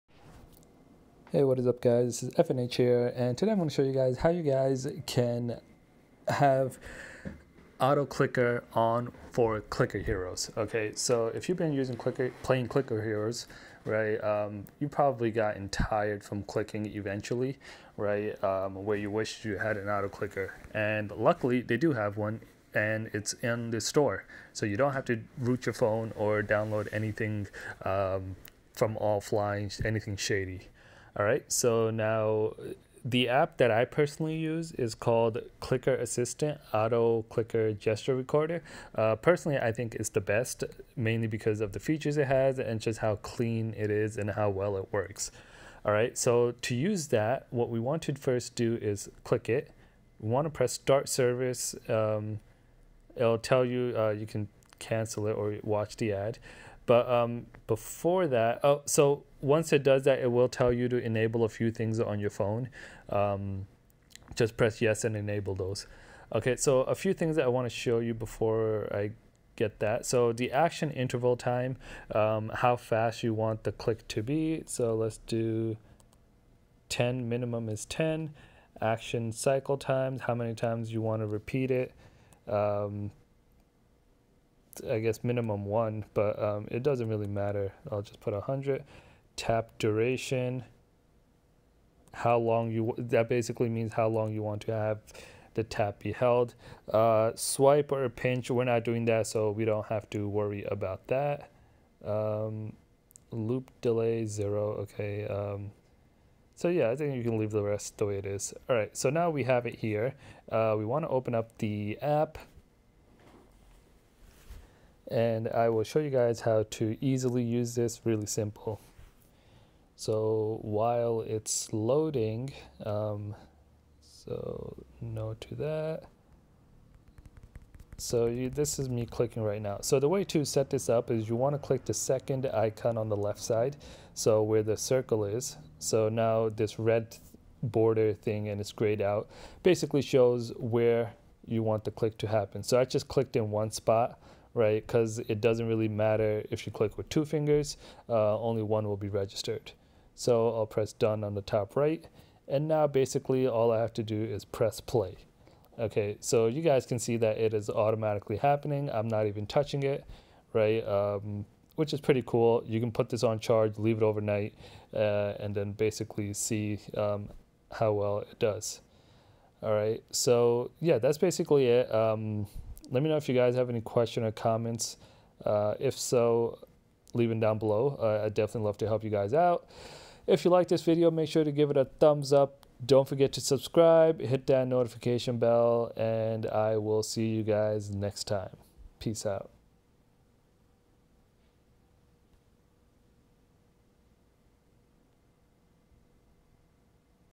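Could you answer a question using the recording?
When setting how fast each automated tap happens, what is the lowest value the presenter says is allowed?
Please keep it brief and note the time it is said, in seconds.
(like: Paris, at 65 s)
10, at 77 s.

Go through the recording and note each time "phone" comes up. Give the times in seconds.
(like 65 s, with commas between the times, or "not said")
25 s, 62 s.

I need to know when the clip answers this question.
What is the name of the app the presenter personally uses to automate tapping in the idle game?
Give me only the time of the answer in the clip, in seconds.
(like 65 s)
35 s.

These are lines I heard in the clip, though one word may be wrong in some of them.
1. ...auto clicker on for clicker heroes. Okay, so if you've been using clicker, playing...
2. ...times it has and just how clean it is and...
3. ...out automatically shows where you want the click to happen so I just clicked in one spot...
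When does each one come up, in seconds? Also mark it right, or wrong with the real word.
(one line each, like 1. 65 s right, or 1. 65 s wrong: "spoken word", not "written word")
1. 7 s right
2. 41 s wrong: "features", not "times"
3. 139 s wrong: "basically", not "automatically".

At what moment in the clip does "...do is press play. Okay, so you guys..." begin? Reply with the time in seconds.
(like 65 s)
154 s.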